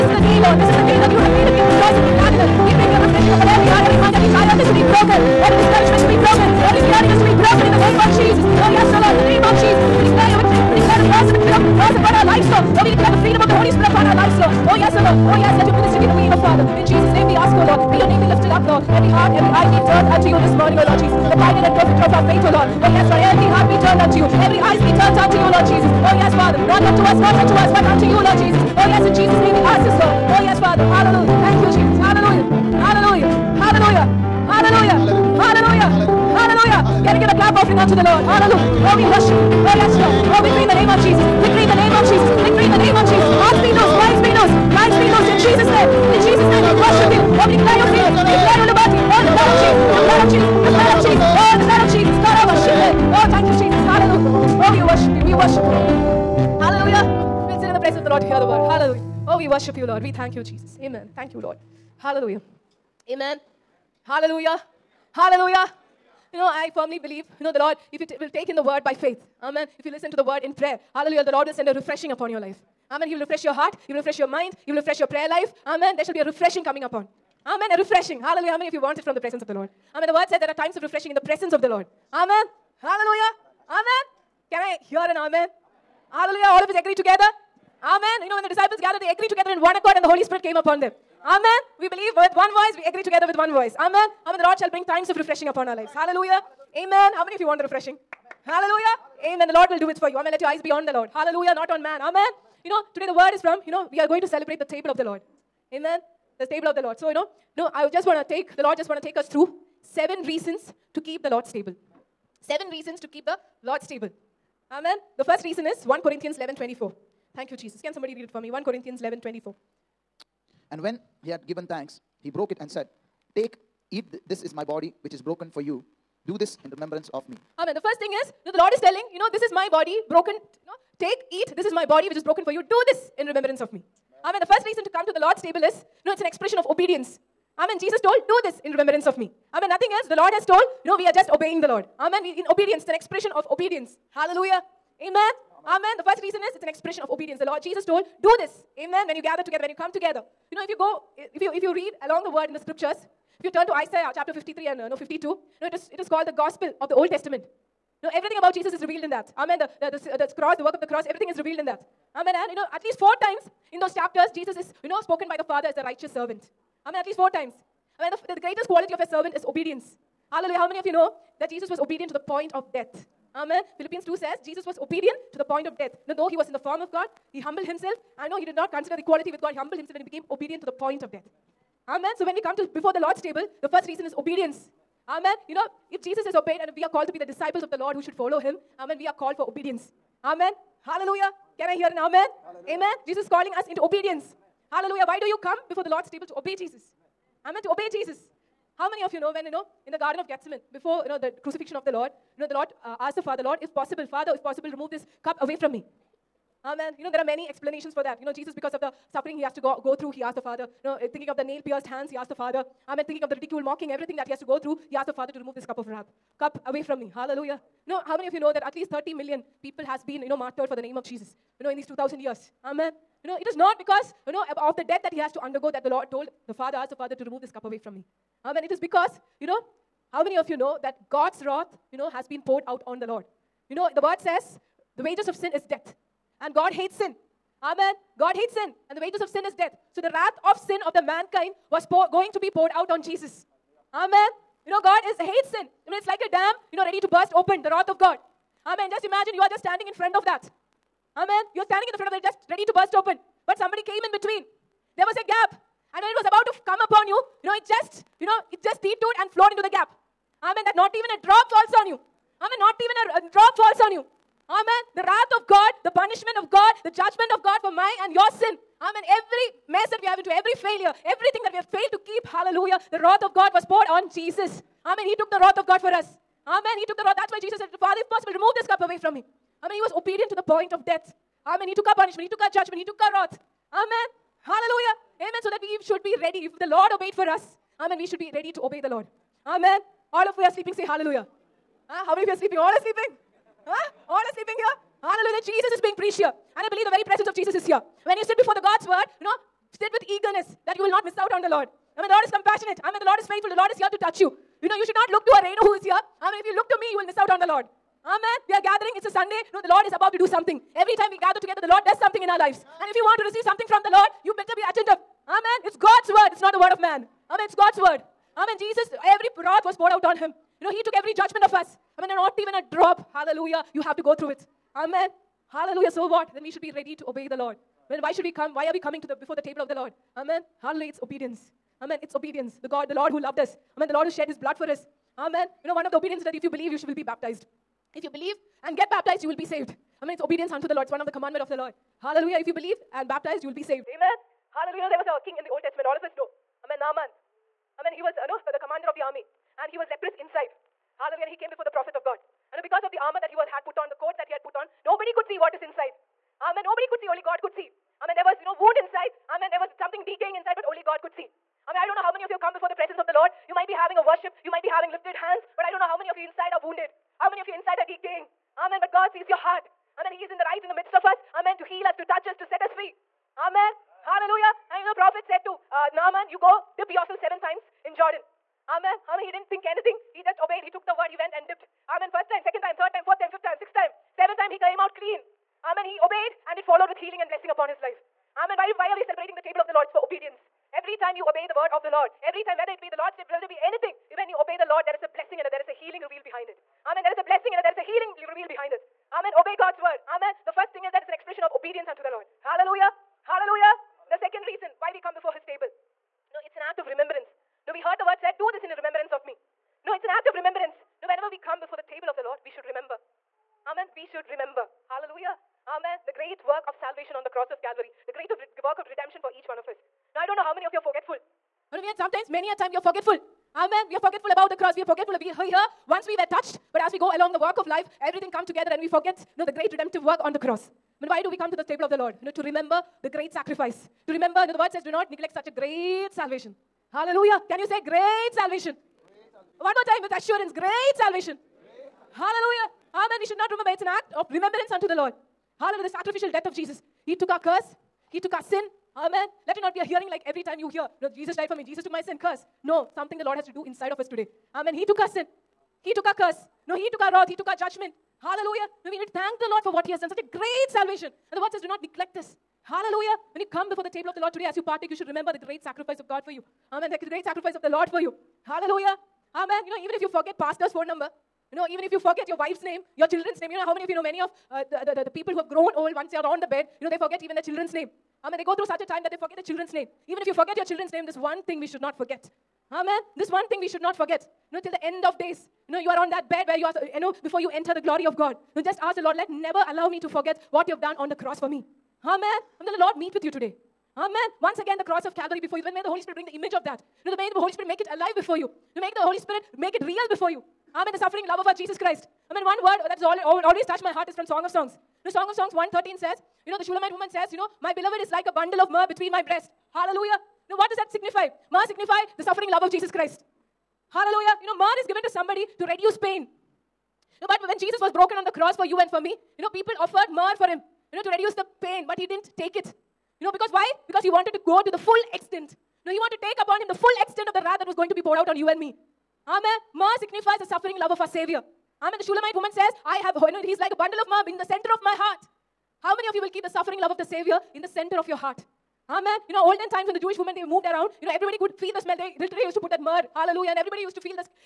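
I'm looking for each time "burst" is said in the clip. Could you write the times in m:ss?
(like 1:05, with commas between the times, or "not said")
4:07, 4:12.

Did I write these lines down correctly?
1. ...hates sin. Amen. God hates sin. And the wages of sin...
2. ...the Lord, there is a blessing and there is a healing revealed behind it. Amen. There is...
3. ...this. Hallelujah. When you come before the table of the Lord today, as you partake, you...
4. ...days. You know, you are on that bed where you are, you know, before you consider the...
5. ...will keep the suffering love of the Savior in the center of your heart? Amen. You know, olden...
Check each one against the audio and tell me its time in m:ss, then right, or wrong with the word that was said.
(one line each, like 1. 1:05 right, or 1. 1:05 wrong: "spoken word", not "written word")
1. 3:56 right
2. 6:34 right
3. 7:42 right
4. 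8:05 wrong: "enter", not "consider"
5. 8:56 right.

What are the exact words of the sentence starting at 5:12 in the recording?
And if you want to receive something from the Lord, you better be attentive.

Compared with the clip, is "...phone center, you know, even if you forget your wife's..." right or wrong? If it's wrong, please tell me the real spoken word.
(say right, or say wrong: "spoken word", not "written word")
wrong: "number", not "center".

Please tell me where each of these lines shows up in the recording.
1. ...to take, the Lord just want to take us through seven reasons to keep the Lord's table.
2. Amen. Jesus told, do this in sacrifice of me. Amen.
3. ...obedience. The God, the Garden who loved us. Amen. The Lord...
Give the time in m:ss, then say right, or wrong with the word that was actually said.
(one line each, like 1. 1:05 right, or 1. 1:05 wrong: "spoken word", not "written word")
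1. 1:48 right
2. 2:17 wrong: "remembrance", not "sacrifice"
3. 5:32 wrong: "Lord", not "Garden".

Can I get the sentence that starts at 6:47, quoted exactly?
No, we heard the word said, Do this in remembrance of me.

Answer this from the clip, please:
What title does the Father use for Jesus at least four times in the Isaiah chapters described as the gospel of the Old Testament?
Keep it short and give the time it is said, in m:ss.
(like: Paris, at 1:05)
righteous servant, at 2:45.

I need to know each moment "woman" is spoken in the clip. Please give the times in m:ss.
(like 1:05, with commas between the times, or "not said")
8:26, 8:52.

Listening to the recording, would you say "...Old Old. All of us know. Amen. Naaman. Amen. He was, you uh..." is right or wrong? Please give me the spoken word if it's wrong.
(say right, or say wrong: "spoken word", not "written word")
wrong: "Testament", not "Old".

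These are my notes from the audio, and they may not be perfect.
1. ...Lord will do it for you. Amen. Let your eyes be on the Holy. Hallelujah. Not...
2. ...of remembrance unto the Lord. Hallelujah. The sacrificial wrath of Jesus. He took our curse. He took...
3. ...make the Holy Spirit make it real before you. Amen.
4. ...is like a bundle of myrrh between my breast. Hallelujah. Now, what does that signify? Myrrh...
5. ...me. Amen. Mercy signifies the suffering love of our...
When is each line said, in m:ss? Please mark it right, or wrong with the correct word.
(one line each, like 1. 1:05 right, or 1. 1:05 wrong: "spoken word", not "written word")
1. 1:39 wrong: "Lord", not "Holy"
2. 7:24 wrong: "death", not "wrath"
3. 8:18 right
4. 8:27 right
5. 8:48 right.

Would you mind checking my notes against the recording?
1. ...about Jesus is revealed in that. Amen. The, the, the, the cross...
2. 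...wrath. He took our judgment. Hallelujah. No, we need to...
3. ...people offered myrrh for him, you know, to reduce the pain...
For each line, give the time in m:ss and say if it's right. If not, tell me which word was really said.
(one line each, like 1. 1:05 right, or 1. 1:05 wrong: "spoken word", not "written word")
1. 2:38 right
2. 7:37 right
3. 8:39 right.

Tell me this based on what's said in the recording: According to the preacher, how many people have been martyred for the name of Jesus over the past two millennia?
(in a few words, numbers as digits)
30 million.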